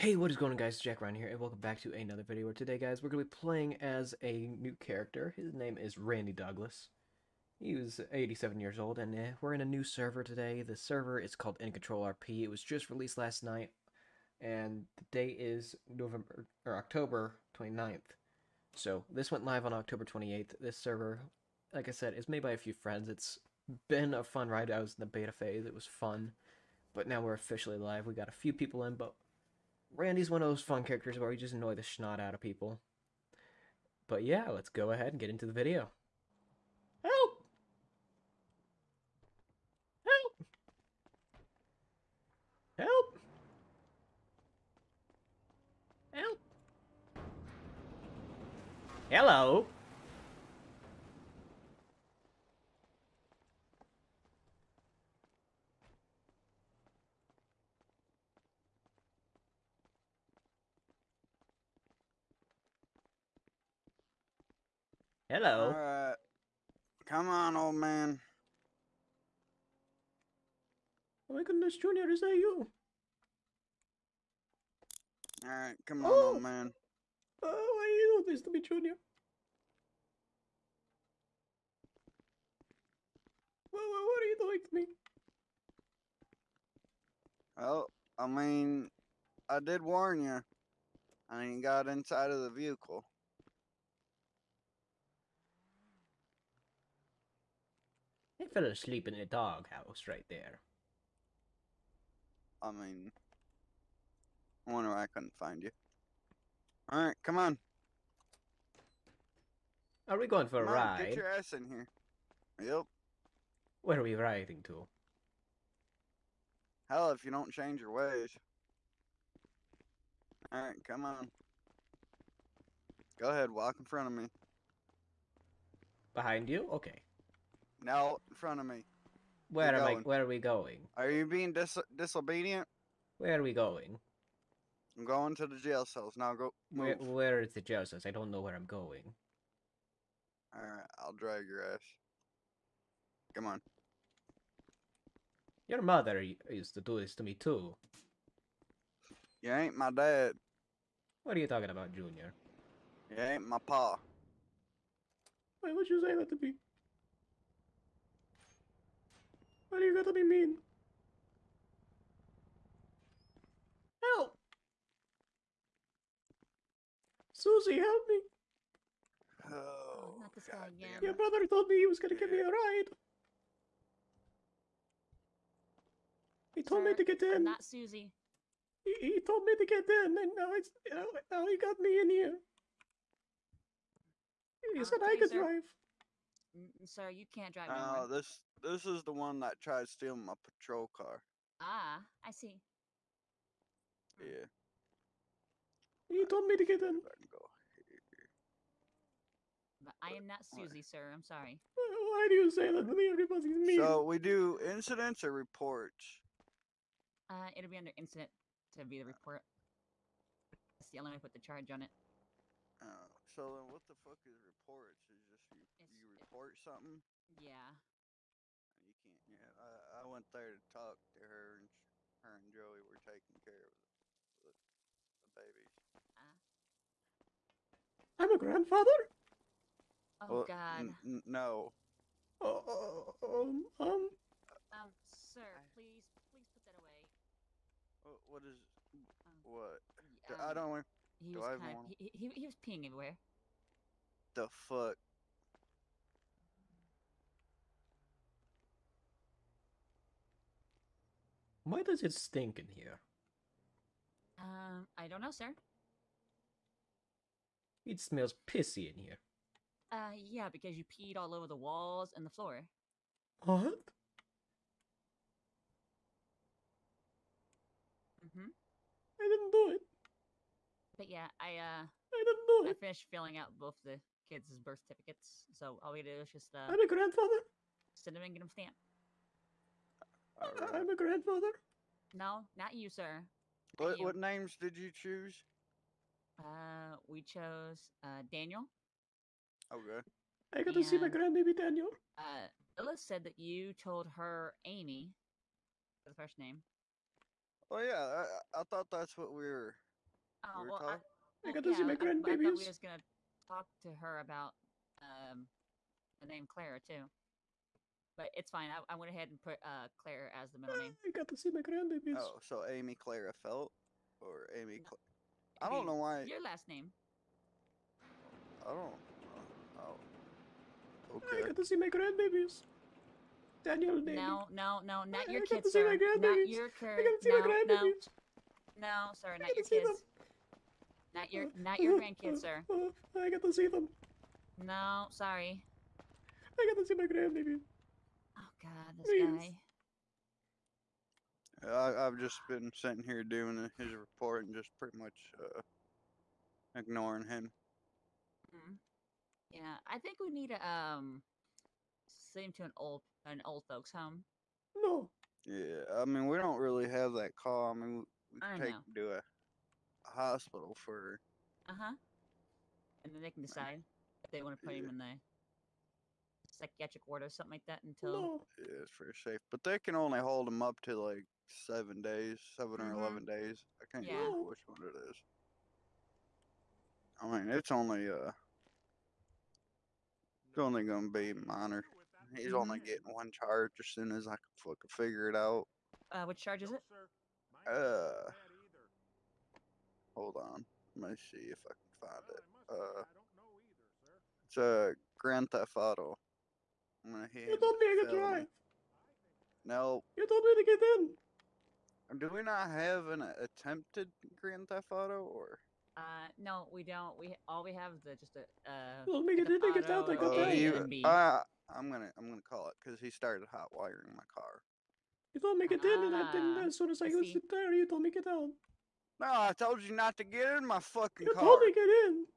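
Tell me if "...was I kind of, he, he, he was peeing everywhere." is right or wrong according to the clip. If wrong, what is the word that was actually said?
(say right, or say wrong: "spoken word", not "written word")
right.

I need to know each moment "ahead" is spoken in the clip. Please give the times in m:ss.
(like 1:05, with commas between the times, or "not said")
0:34, 2:03, 5:09.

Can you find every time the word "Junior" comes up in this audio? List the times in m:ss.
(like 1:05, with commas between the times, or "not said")
1:11, 1:18, 2:31.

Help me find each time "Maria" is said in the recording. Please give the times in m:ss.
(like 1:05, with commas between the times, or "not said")
not said.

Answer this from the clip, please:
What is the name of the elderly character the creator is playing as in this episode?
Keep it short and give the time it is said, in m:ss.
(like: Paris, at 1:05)
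Randy Douglas, at 0:05.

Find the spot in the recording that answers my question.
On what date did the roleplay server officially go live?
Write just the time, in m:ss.
0:19.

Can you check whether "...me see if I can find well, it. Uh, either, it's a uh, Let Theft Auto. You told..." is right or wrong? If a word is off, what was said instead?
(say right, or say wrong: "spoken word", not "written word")
wrong: "Grand", not "Let".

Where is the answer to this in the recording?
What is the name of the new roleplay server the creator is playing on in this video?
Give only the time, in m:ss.
0:11.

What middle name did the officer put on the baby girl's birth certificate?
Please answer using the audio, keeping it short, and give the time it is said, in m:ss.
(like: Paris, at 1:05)
Claire, at 5:10.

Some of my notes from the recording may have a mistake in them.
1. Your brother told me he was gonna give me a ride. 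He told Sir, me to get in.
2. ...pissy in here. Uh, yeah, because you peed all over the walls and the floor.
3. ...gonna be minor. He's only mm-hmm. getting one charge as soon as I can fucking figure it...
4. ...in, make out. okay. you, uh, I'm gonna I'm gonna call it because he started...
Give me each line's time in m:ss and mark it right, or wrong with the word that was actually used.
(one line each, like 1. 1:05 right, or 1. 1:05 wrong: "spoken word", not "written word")
1. 2:51 right
2. 4:18 right
3. 6:20 right
4. 6:49 right.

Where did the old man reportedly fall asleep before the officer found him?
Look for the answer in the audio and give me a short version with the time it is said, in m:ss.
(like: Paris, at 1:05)
the doghouse, at 1:39.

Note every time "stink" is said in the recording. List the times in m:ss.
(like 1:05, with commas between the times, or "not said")
4:12.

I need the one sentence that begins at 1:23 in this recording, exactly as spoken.
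What, what, what are you doing to me?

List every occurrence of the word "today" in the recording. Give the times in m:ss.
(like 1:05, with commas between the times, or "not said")
0:02, 0:10.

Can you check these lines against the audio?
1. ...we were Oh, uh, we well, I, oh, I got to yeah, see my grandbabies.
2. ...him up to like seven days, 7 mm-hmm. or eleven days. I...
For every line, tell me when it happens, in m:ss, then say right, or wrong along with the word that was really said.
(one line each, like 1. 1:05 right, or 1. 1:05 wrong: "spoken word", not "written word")
1. 4:59 right
2. 6:10 right.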